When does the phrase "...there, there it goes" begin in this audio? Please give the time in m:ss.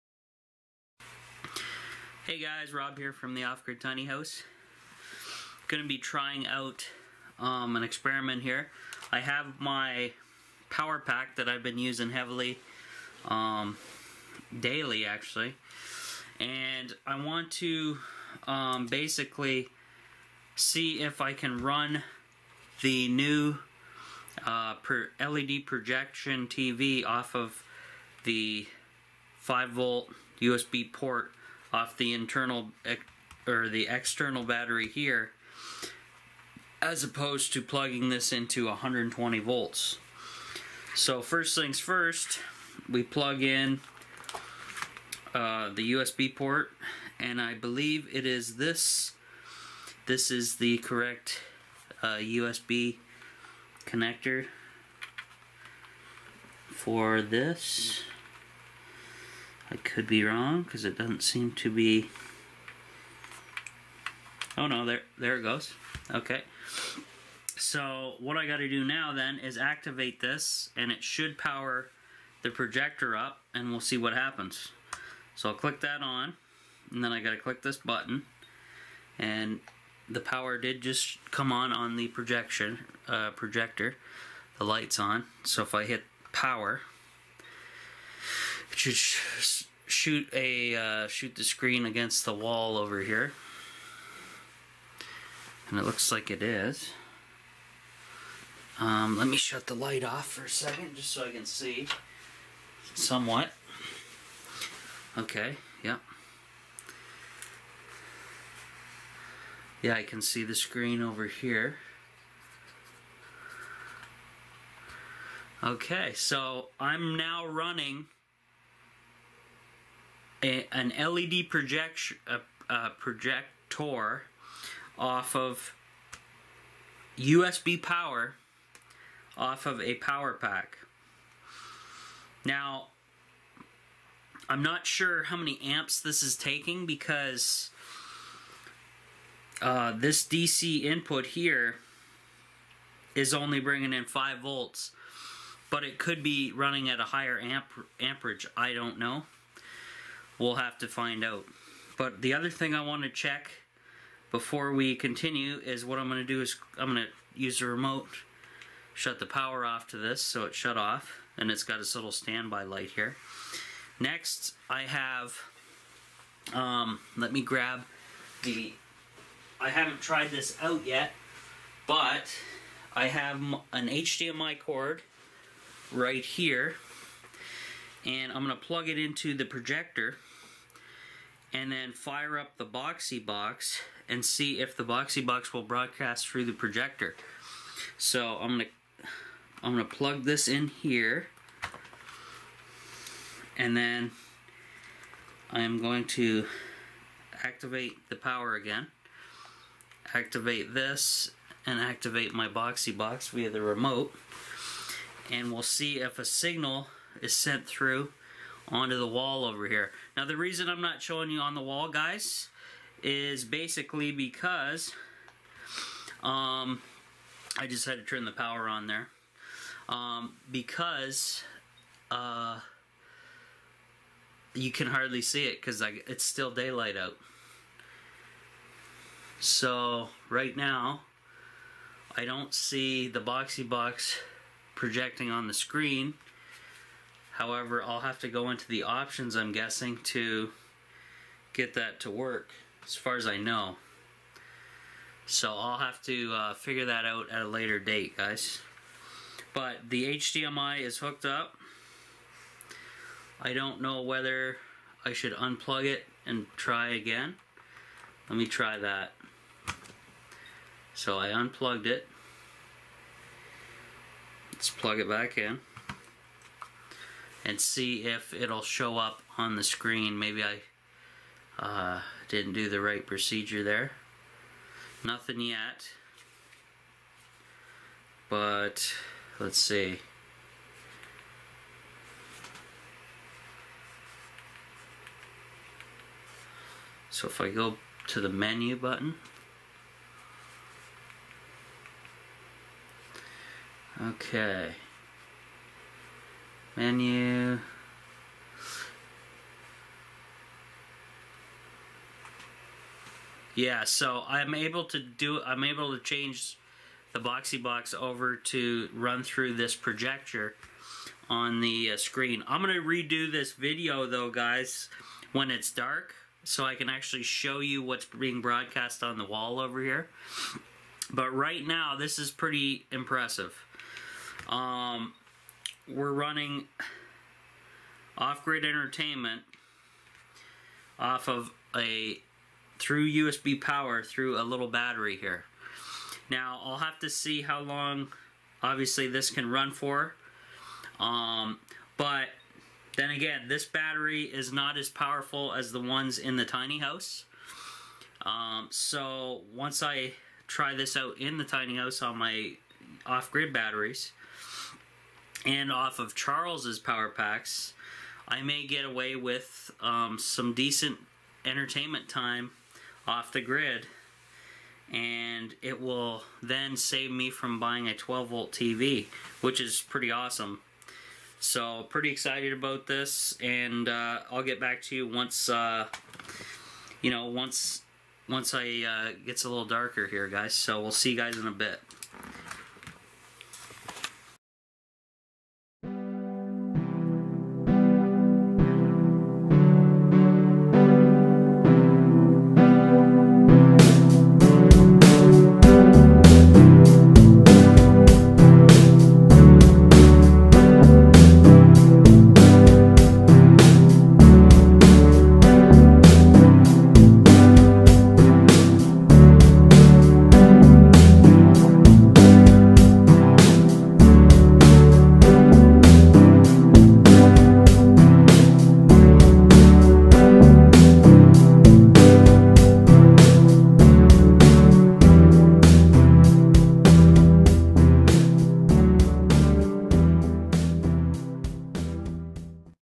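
1:04.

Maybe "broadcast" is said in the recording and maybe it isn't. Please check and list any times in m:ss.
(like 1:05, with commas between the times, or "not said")
3:05, 5:18.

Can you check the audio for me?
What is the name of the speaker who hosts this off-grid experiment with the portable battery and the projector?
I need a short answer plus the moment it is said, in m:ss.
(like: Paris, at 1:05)
Rob, at 0:02.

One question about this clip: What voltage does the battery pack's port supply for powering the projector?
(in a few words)
5 volts.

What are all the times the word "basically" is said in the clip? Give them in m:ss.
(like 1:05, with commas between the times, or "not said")
0:18, 3:33.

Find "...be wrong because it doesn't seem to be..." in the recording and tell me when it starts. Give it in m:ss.
1:00.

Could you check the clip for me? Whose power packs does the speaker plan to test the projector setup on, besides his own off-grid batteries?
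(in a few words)
Charles's.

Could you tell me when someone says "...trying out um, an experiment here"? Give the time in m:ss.
0:05.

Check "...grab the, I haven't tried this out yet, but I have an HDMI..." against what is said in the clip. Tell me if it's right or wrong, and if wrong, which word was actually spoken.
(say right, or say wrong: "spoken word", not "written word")
right.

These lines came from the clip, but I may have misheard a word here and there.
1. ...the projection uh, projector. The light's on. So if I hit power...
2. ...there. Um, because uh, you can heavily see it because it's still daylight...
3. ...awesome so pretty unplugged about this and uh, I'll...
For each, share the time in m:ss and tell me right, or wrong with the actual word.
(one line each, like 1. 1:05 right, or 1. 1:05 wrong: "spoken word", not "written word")
1. 1:21 right
2. 3:38 wrong: "hardly", not "heavily"
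3. 6:10 wrong: "excited", not "unplugged".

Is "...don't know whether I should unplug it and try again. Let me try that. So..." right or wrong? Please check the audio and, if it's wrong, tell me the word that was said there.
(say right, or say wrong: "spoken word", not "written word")
right.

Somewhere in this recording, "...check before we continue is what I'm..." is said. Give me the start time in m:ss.
2:33.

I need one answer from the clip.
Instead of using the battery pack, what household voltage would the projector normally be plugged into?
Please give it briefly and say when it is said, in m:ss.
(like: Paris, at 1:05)
120 volts, at 0:38.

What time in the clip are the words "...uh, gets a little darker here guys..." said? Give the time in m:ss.
6:18.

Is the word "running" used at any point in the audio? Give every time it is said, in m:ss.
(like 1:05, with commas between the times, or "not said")
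1:57, 2:26, 5:26.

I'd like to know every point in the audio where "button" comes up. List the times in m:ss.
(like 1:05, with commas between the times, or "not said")
1:17, 4:48.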